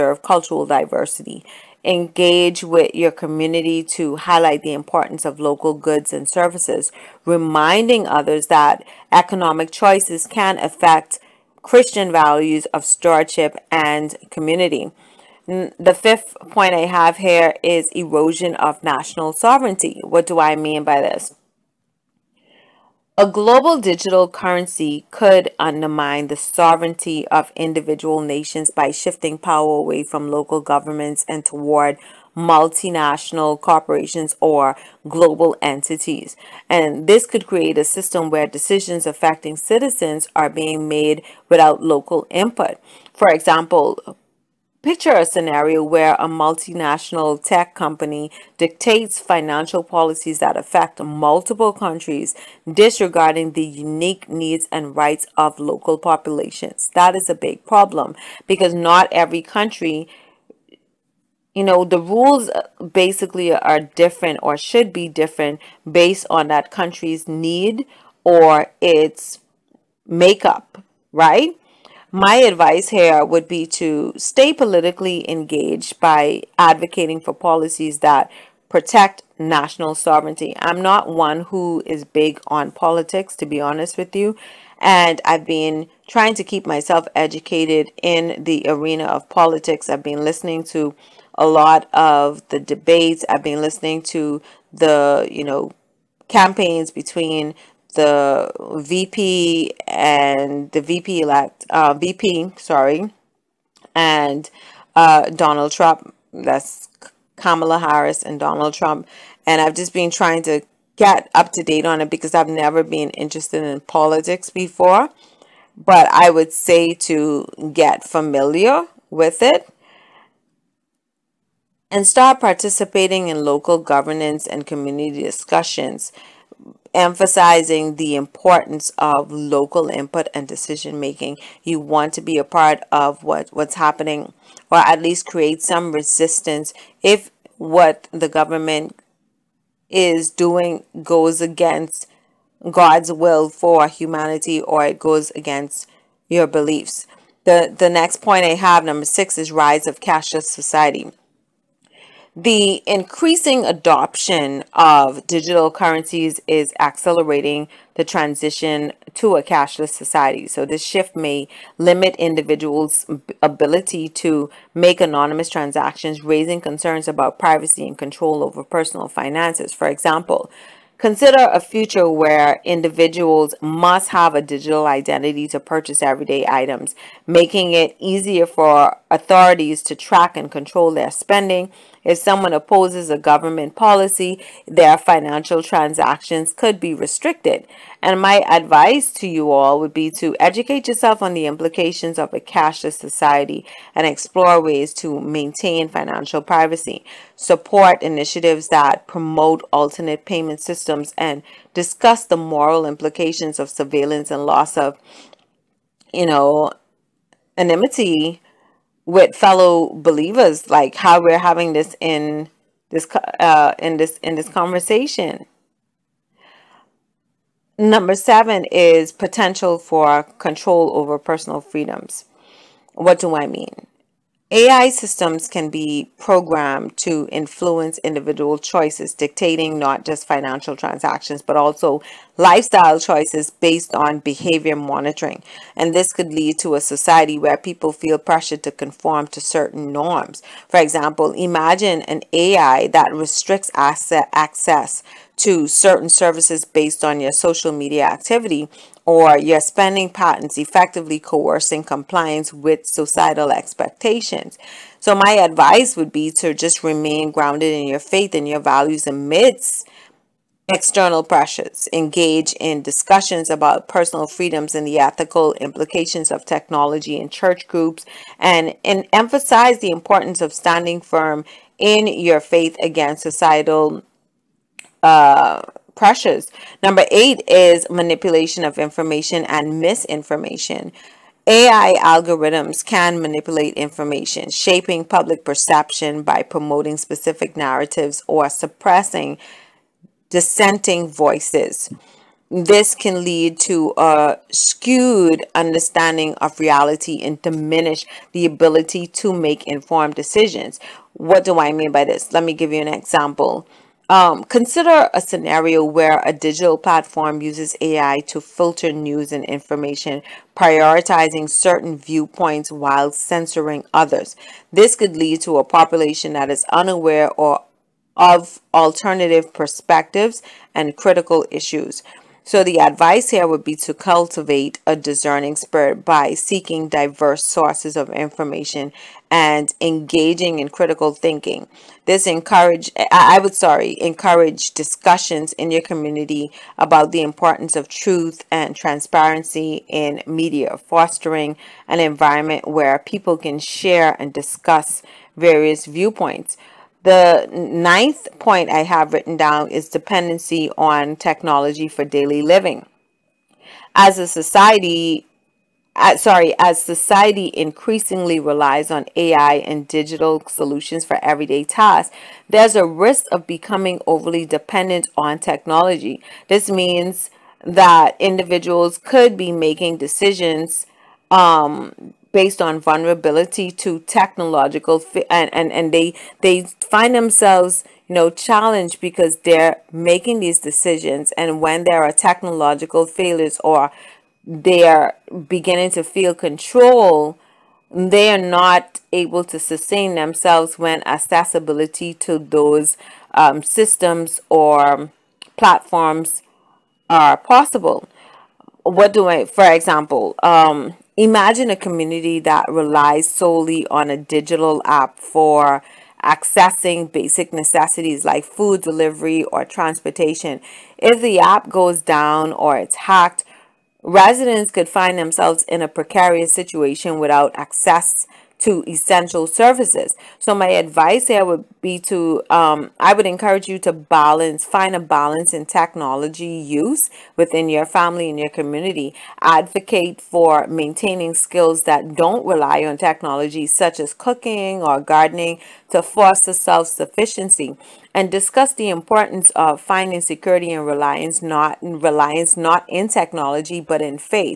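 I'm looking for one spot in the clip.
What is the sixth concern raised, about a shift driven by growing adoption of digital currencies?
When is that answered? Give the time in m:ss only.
2:29.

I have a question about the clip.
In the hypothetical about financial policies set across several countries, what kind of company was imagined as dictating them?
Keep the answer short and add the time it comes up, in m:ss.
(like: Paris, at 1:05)
multinational tech company, at 0:46.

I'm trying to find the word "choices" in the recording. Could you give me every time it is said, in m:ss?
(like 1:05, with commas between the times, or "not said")
0:09, 3:48, 3:52.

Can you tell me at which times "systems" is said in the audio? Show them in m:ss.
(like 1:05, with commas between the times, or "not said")
0:37, 3:20, 3:44, 6:33.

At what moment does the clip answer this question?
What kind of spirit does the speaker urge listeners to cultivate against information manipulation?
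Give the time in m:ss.
5:24.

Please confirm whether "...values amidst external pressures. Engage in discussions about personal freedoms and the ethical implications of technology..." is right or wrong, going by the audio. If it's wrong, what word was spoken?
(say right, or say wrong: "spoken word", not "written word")
right.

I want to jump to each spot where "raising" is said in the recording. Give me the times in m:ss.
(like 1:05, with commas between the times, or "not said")
2:46.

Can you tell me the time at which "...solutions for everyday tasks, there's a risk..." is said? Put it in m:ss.
6:00.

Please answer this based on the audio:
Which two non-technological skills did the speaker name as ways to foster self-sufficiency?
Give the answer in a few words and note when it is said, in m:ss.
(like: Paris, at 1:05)
cooking or gardening, at 7:14.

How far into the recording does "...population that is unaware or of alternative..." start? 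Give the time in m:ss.
5:15.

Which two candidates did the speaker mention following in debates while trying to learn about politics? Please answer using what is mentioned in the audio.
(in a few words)
Kamala Harris and Donald Trump.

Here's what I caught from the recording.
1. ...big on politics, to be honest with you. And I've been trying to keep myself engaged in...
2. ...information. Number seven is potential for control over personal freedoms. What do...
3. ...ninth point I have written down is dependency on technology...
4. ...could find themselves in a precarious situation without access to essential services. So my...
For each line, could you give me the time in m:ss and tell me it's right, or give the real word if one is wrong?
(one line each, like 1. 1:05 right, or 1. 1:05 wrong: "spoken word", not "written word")
1. 1:22 wrong: "educated", not "engaged"
2. 3:34 wrong: "conversation", not "information"
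3. 5:47 right
4. 6:54 right.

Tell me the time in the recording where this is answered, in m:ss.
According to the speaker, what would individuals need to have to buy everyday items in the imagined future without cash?
2:54.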